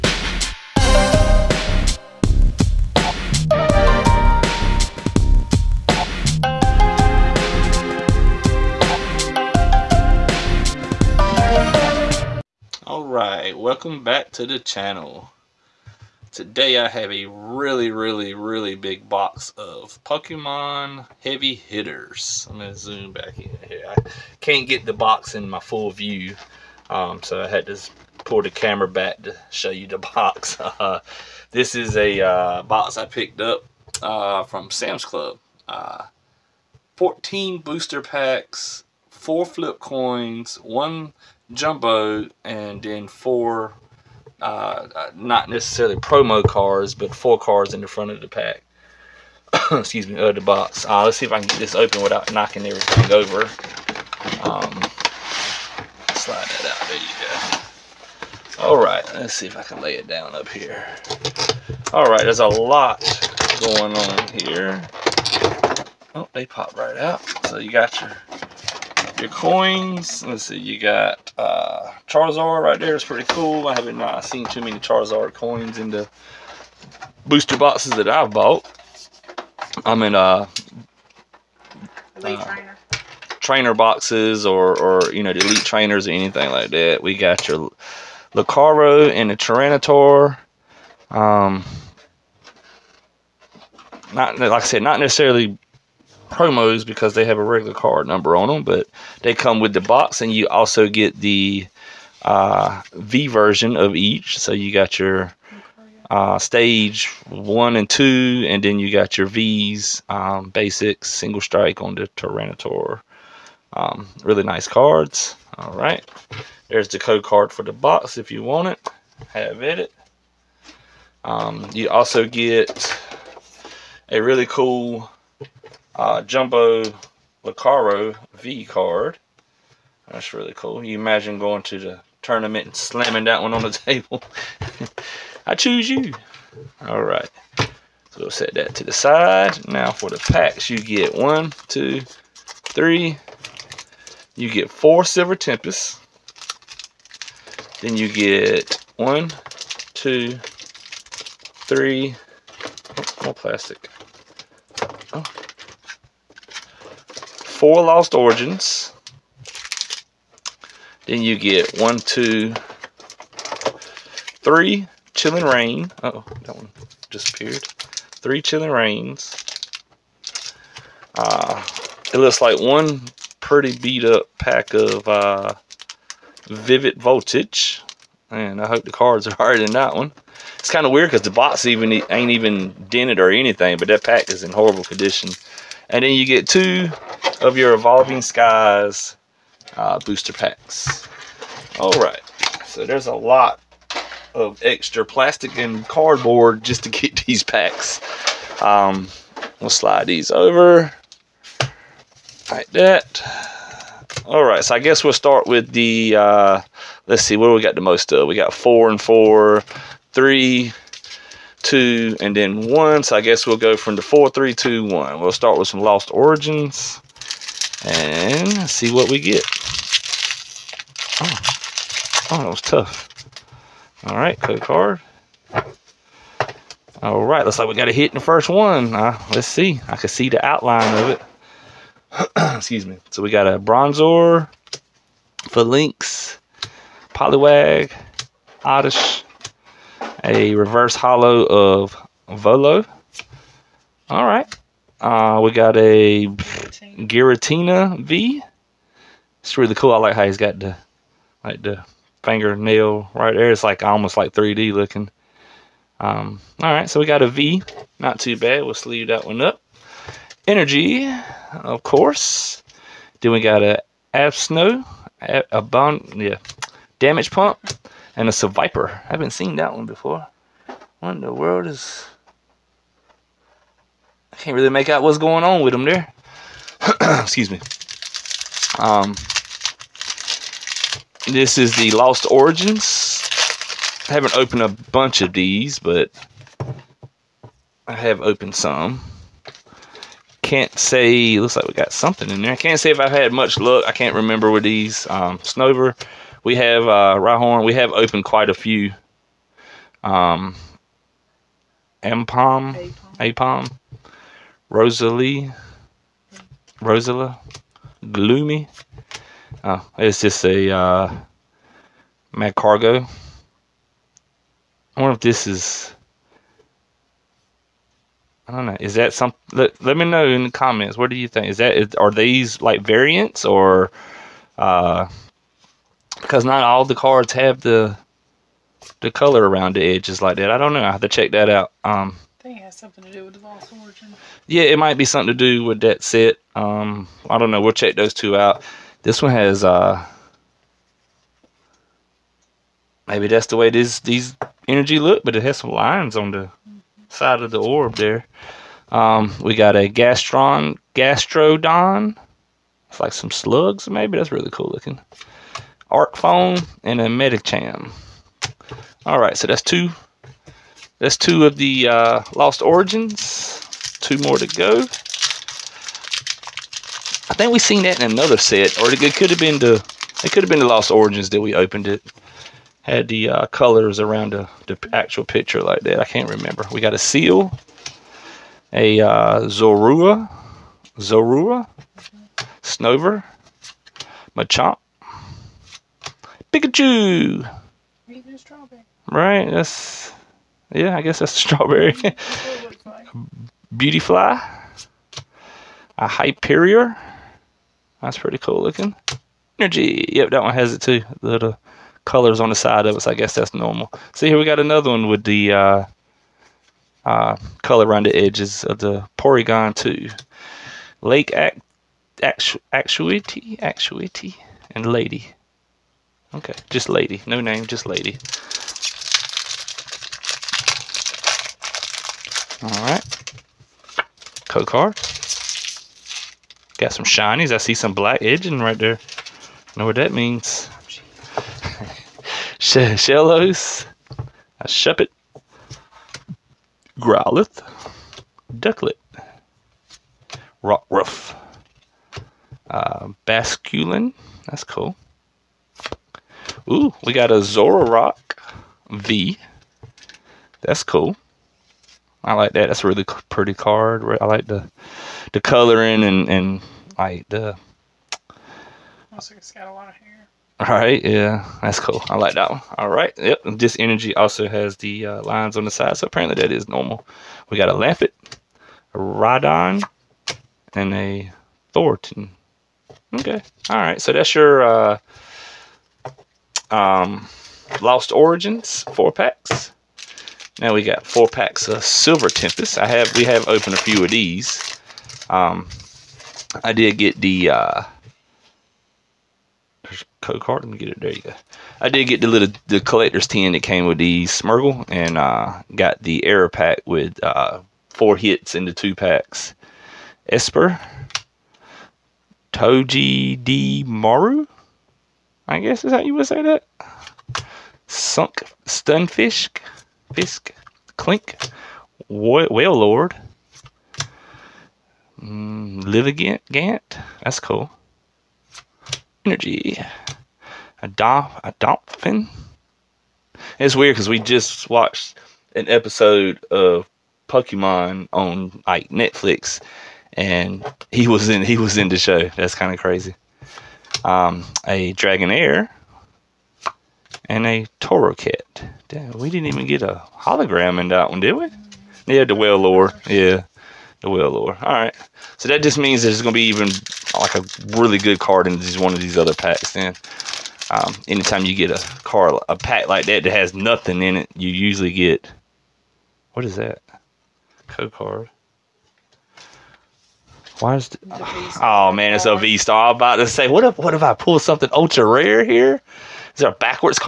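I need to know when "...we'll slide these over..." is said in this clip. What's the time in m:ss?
3:19.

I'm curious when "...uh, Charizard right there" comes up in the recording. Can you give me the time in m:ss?
1:11.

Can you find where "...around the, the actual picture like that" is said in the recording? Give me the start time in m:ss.
6:14.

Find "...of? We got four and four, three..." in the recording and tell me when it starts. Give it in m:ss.
3:28.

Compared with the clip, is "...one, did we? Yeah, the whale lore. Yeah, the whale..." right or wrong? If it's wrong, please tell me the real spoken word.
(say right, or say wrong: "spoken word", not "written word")
right.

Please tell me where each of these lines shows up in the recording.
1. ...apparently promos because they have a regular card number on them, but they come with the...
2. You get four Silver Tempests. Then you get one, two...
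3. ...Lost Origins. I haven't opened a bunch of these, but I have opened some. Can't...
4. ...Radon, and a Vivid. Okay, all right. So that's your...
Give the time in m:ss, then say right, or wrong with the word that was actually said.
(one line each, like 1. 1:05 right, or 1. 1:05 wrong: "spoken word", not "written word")
1. 1:34 wrong: "necessarily", not "apparently"
2. 2:24 right
3. 4:41 right
4. 7:48 wrong: "Thornton", not "Vivid".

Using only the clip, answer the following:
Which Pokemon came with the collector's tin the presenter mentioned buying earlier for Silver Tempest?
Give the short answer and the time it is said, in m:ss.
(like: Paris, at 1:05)
Smeargle, at 8:14.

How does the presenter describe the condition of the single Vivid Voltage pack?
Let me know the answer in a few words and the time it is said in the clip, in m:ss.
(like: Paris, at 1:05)
Pretty beat up, at 2:53.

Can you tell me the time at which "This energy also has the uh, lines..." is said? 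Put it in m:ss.
7:43.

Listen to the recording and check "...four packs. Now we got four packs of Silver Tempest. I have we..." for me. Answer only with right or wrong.
right.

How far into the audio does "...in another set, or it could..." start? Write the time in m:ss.
6:08.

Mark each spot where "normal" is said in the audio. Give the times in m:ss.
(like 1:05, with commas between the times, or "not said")
6:43, 7:46.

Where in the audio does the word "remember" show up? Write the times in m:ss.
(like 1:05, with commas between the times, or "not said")
4:54, 6:16.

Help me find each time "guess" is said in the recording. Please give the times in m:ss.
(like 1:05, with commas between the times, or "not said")
3:24, 3:33, 6:31, 6:43, 8:25.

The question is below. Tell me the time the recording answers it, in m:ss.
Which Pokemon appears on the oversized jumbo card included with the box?
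2:06.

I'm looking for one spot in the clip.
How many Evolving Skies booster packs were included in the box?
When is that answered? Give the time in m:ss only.
3:06.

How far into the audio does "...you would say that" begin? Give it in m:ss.
8:25.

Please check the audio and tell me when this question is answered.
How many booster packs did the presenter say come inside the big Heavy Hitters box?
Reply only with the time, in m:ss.
0:36.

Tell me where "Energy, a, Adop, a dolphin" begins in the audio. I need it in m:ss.
8:39.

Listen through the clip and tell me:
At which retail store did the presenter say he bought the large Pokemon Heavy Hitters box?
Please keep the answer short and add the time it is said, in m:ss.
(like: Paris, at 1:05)
Sam's Club, at 0:34.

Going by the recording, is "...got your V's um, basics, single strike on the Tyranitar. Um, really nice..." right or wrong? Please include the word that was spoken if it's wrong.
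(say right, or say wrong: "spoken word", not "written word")
right.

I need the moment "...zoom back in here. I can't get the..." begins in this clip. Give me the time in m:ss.
0:22.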